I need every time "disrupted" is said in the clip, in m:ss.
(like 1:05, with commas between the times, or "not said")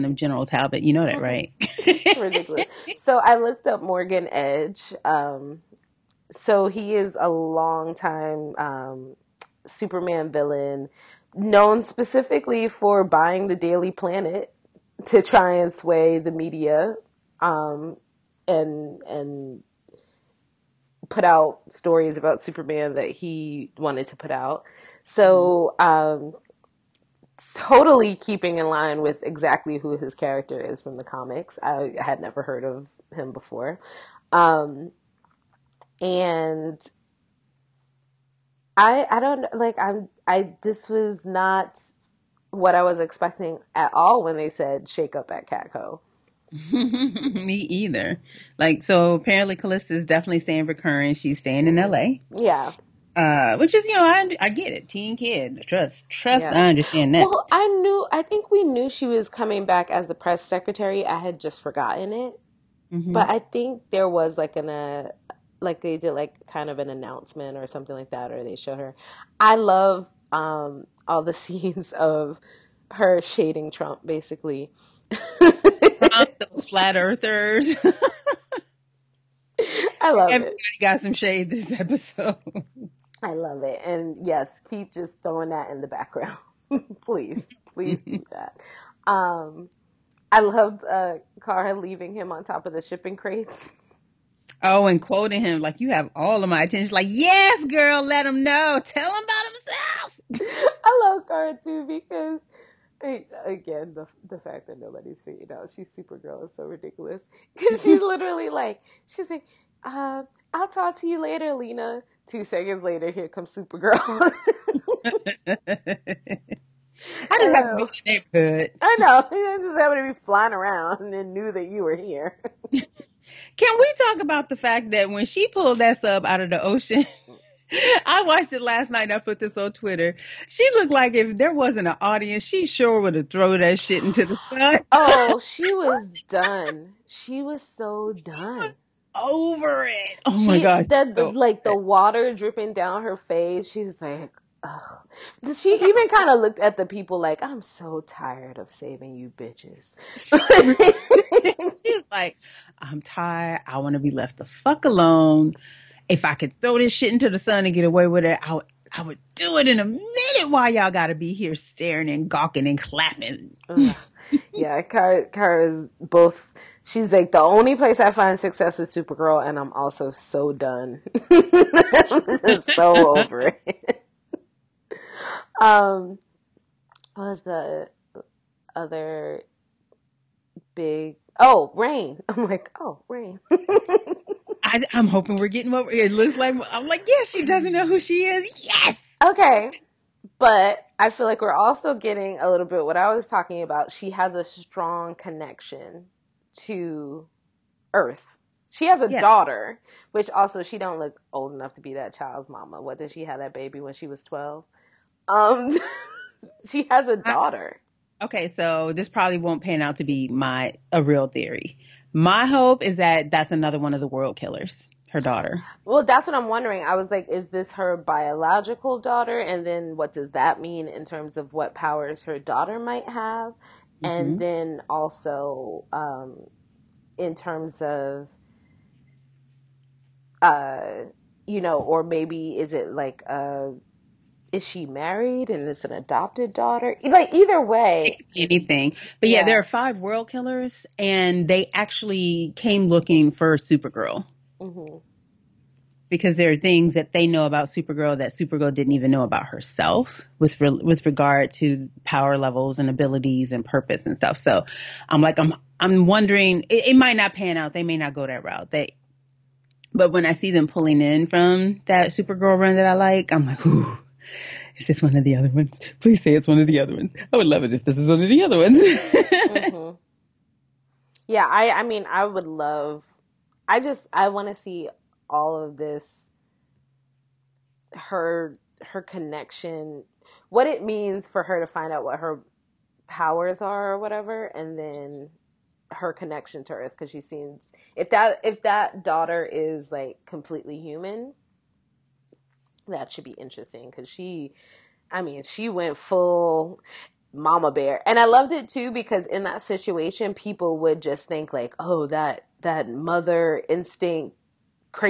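not said.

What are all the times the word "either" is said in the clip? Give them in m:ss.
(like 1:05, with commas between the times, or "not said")
0:47, 3:57.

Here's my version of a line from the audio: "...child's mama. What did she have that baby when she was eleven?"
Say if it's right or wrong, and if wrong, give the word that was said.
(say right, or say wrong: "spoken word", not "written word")
wrong: "twelve", not "eleven".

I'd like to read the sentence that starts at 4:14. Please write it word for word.
So I'm like, I'm I'm wondering it, it might not pan out.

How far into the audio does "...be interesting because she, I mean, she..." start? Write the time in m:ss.
4:53.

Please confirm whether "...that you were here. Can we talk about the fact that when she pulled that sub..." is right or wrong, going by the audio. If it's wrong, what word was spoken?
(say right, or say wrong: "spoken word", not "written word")
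right.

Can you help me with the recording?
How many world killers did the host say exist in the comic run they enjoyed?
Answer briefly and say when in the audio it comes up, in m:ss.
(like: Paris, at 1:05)
5, at 3:59.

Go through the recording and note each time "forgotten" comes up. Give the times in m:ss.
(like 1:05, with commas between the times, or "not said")
1:01.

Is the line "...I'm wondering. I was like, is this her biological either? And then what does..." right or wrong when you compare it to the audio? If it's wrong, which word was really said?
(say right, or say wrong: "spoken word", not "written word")
wrong: "daughter", not "either".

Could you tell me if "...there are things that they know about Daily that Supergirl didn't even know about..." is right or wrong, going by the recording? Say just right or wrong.
wrong.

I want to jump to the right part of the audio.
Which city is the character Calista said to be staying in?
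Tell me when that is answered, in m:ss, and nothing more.
0:51.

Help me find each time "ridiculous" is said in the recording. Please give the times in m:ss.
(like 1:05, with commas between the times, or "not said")
0:02, 1:46.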